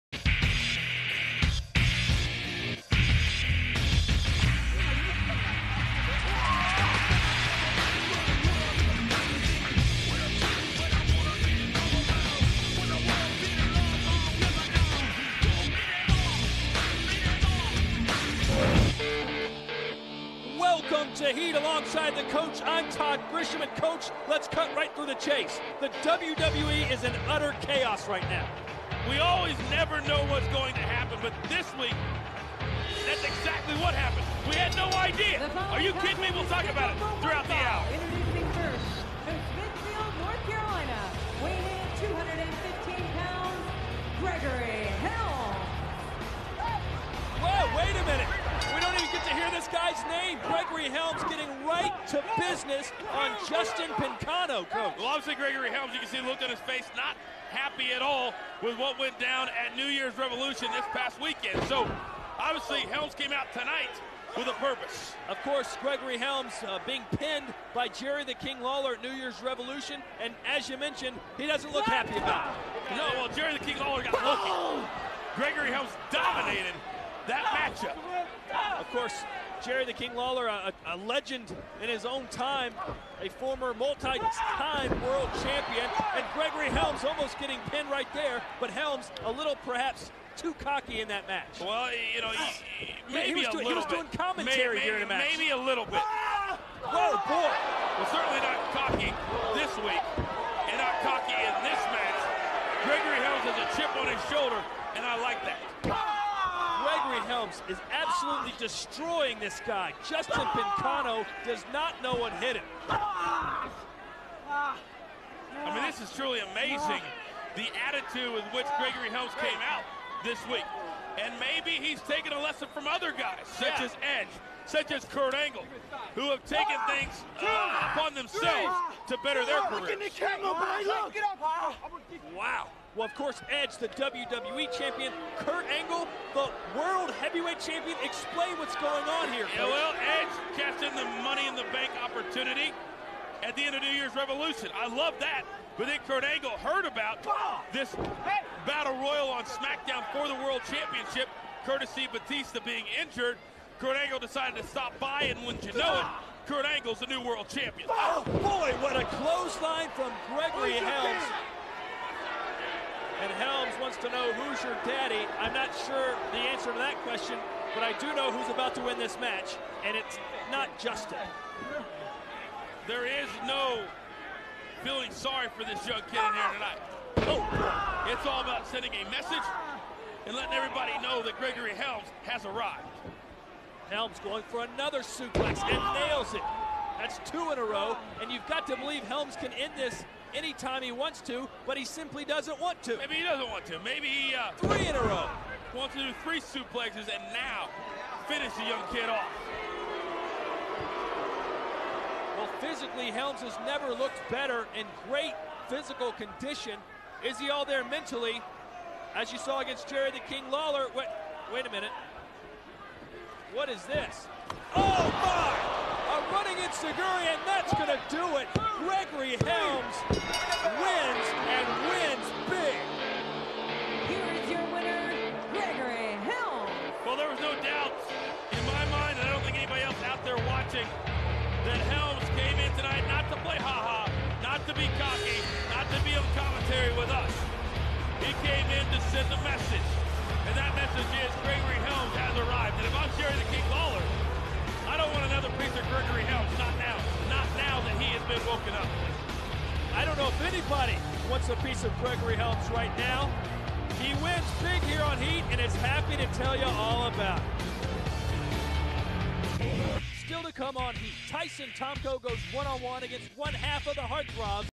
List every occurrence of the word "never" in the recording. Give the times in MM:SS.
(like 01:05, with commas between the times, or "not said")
00:29, 03:23.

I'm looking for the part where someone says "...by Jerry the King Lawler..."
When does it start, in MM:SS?
01:07.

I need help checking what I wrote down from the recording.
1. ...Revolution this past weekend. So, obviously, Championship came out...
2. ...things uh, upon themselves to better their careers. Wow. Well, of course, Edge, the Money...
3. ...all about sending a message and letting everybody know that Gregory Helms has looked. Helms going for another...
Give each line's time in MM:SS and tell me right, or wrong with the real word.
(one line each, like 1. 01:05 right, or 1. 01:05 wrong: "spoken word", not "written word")
1. 01:00 wrong: "Helms", not "Championship"
2. 02:06 wrong: "WWE", not "Money"
3. 02:58 wrong: "arrived", not "looked".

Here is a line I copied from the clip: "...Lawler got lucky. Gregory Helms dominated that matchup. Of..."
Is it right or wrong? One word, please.
right.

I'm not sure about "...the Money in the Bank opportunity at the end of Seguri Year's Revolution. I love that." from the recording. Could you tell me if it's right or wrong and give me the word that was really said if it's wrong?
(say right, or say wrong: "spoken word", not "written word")
wrong: "New", not "Seguri".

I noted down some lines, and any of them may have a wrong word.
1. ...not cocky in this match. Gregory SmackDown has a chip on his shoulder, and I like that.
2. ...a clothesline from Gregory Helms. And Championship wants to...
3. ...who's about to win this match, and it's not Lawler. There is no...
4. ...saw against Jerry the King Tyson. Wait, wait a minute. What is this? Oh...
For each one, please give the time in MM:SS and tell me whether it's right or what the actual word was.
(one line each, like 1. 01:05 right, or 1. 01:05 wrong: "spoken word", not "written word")
1. 01:40 wrong: "Helms", not "SmackDown"
2. 02:38 wrong: "Helms", not "Championship"
3. 02:48 wrong: "Justin", not "Lawler"
4. 03:29 wrong: "Lawler", not "Tyson".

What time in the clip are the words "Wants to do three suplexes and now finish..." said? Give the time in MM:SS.
03:15.